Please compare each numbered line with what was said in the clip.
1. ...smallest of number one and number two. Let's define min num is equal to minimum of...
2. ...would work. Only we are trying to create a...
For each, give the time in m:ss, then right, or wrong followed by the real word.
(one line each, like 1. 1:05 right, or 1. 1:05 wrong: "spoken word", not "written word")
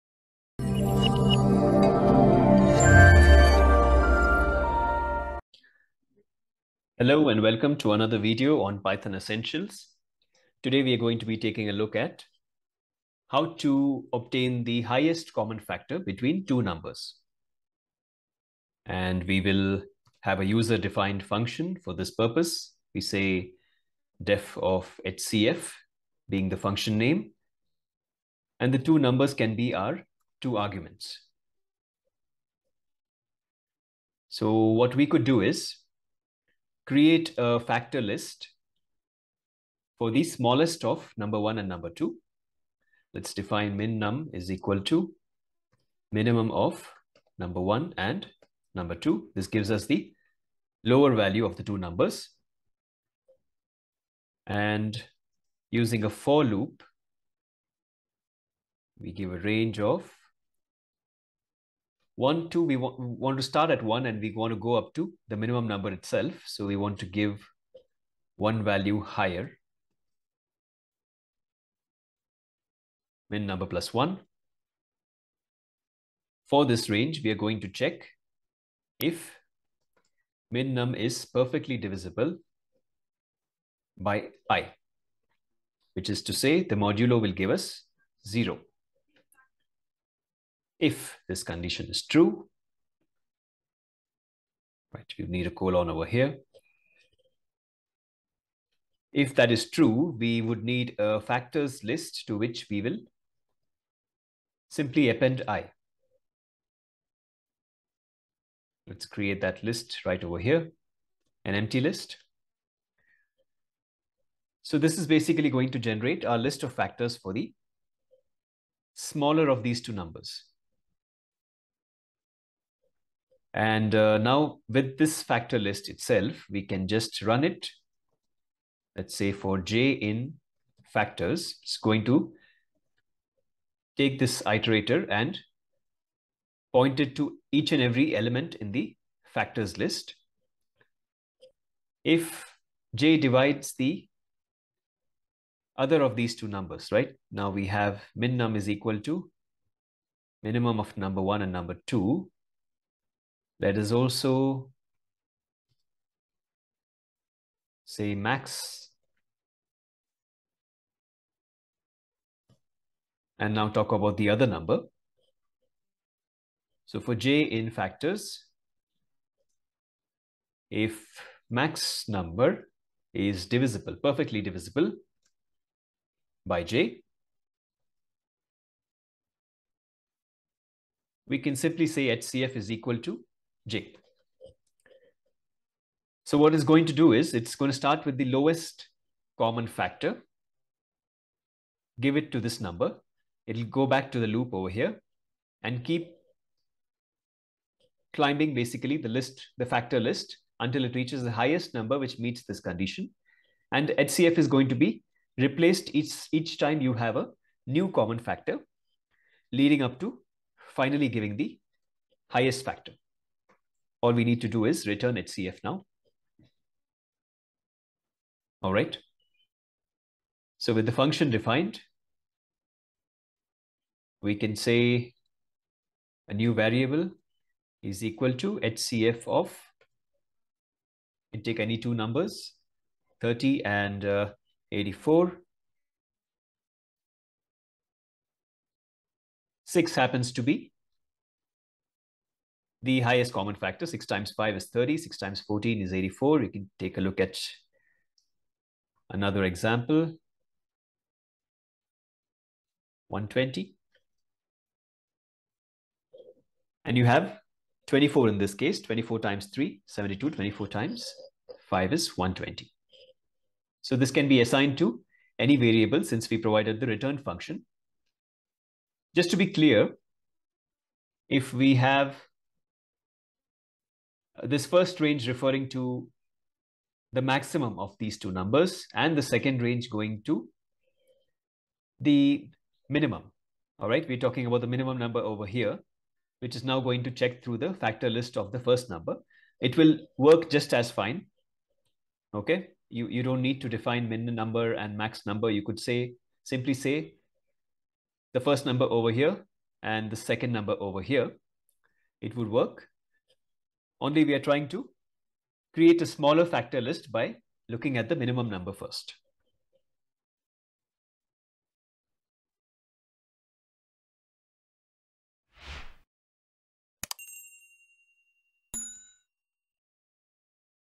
1. 0:40 right
2. 5:02 right.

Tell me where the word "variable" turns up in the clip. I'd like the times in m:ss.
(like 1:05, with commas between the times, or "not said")
3:46, 4:25.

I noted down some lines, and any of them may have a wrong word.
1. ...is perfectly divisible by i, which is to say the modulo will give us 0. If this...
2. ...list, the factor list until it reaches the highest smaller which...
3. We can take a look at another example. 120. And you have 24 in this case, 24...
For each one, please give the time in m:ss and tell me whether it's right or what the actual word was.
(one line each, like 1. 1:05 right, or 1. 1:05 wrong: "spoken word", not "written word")
1. 1:20 right
2. 3:19 wrong: "number", not "smaller"
3. 4:06 right.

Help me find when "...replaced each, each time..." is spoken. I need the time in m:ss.
3:25.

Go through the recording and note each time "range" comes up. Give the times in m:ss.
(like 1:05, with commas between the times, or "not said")
0:59, 1:16, 4:34, 4:39.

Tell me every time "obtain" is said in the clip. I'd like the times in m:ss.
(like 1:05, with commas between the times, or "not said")
0:14.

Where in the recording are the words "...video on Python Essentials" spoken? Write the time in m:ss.
0:08.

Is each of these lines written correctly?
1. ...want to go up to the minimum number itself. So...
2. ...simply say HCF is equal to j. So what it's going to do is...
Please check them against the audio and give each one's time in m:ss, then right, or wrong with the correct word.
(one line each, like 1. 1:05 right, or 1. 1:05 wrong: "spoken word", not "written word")
1. 1:04 right
2. 3:01 right.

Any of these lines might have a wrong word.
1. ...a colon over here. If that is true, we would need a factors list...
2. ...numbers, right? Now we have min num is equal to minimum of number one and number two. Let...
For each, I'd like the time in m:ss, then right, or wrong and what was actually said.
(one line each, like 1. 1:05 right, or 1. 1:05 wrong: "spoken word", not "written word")
1. 1:35 right
2. 2:26 right.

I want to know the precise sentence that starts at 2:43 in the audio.
And now talk about the other number.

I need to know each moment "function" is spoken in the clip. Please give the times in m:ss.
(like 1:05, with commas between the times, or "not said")
0:21, 0:26, 3:40, 4:27.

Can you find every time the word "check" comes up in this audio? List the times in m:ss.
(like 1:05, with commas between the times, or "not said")
1:17, 4:47.